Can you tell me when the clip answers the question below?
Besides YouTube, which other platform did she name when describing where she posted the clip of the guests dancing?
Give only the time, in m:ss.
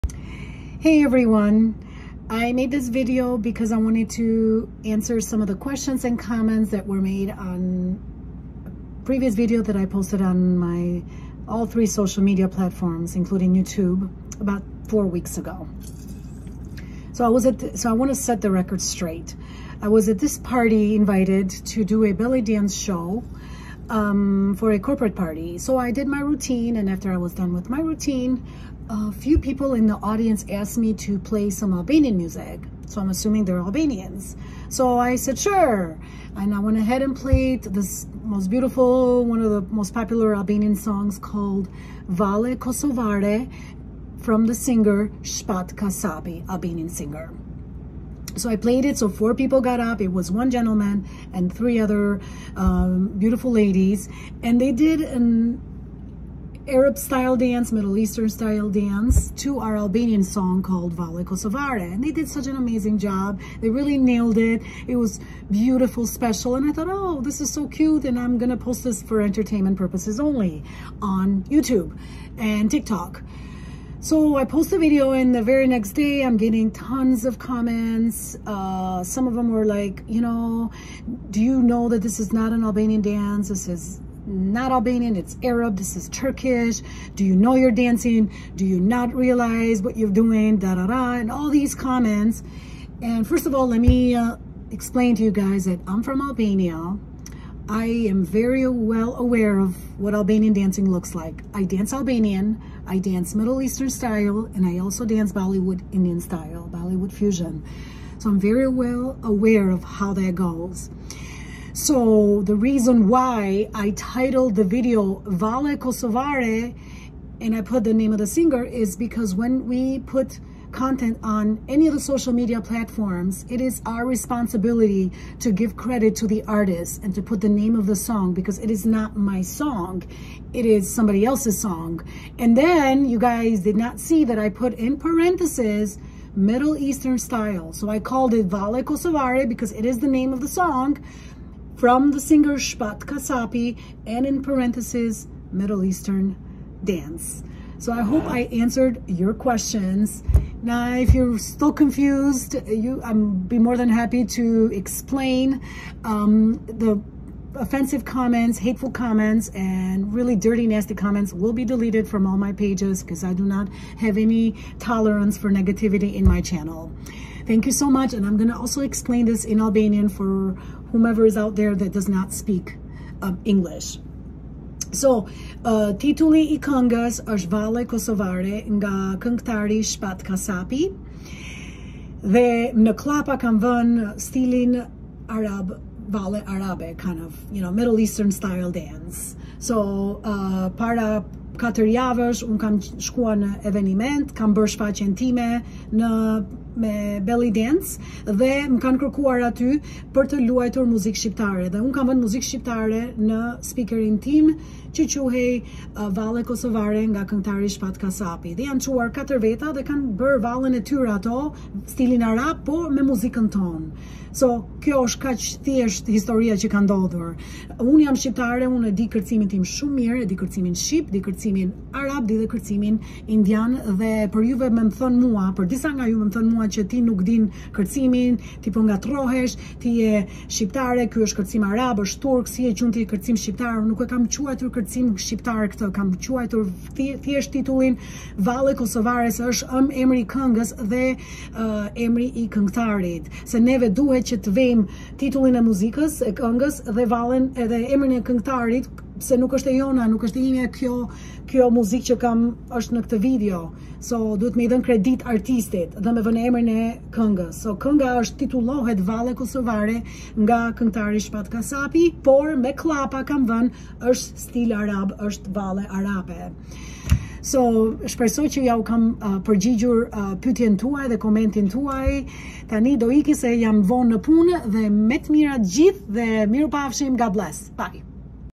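1:12.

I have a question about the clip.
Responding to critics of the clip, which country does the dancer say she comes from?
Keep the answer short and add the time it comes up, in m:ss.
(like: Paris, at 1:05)
Albania, at 1:36.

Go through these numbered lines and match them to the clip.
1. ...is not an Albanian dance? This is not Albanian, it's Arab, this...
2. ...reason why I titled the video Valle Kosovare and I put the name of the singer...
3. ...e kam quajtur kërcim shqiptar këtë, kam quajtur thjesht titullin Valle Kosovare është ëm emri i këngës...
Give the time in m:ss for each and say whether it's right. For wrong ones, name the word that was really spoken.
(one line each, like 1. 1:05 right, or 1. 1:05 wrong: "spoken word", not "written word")
1. 1:22 right
2. 1:52 right
3. 3:54 right.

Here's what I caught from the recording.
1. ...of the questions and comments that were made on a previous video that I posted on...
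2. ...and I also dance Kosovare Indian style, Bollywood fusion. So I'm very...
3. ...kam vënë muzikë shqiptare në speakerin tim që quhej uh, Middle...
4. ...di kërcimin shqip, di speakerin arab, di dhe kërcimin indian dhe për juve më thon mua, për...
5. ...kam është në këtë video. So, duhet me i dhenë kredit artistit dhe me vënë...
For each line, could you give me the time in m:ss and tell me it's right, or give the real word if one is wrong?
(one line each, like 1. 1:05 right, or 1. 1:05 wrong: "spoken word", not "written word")
1. 0:05 right
2. 1:44 wrong: "Bollywood", not "Kosovare"
3. 3:21 wrong: "Valle", not "Middle"
4. 3:40 wrong: "kërcimin", not "speakerin"
5. 4:12 right.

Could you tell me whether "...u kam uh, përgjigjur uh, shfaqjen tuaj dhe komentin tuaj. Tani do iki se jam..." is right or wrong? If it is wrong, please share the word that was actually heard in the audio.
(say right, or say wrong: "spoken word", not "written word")
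wrong: "pytjen", not "shfaqjen".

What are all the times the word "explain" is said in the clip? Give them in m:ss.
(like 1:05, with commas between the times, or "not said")
1:34, 2:34, 2:48.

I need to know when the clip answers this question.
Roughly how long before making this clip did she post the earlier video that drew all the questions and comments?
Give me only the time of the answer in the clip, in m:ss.
0:14.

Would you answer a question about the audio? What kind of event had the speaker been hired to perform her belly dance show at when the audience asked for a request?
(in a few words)
Corporate party.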